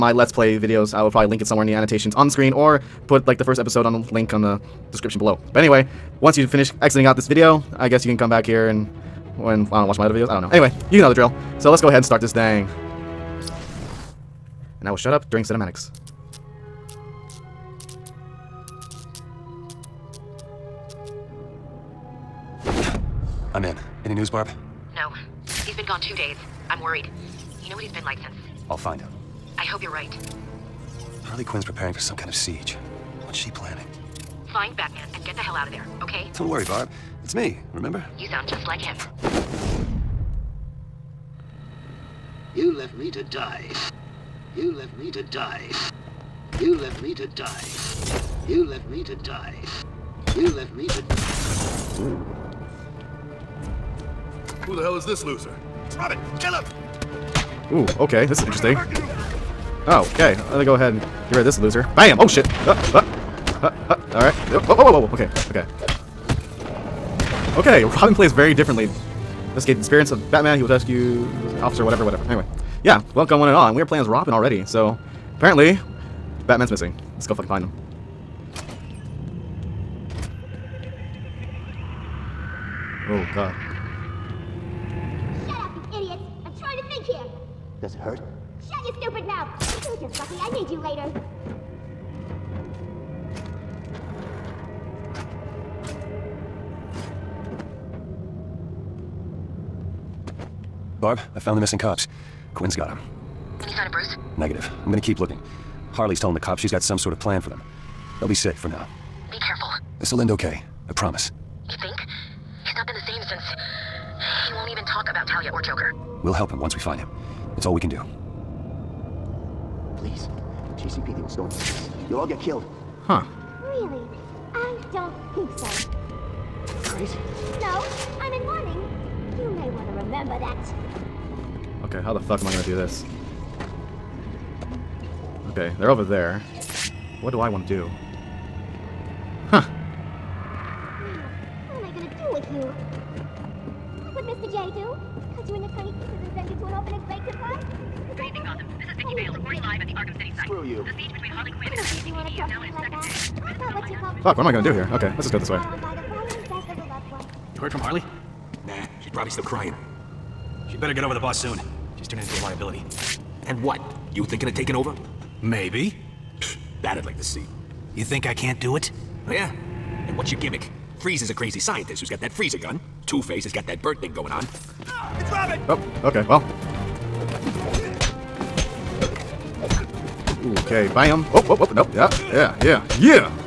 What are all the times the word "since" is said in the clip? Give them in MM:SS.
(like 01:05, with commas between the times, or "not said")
00:28, 01:53.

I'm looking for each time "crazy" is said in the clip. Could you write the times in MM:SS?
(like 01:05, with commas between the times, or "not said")
02:06, 02:51.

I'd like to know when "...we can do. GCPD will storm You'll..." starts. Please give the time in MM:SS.
01:57.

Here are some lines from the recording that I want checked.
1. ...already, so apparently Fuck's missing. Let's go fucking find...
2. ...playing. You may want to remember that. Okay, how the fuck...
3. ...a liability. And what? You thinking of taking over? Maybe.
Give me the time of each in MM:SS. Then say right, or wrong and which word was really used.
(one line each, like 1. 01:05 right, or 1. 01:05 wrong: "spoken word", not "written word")
1. 01:14 wrong: "Batman", not "Fuck"
2. 02:08 wrong: "warning", not "playing"
3. 02:42 right.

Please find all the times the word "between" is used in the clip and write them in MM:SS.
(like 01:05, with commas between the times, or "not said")
02:31.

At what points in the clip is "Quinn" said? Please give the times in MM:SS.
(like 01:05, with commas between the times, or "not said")
00:31, 01:42, 02:31.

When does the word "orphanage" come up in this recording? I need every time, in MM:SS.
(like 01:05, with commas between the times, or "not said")
02:26.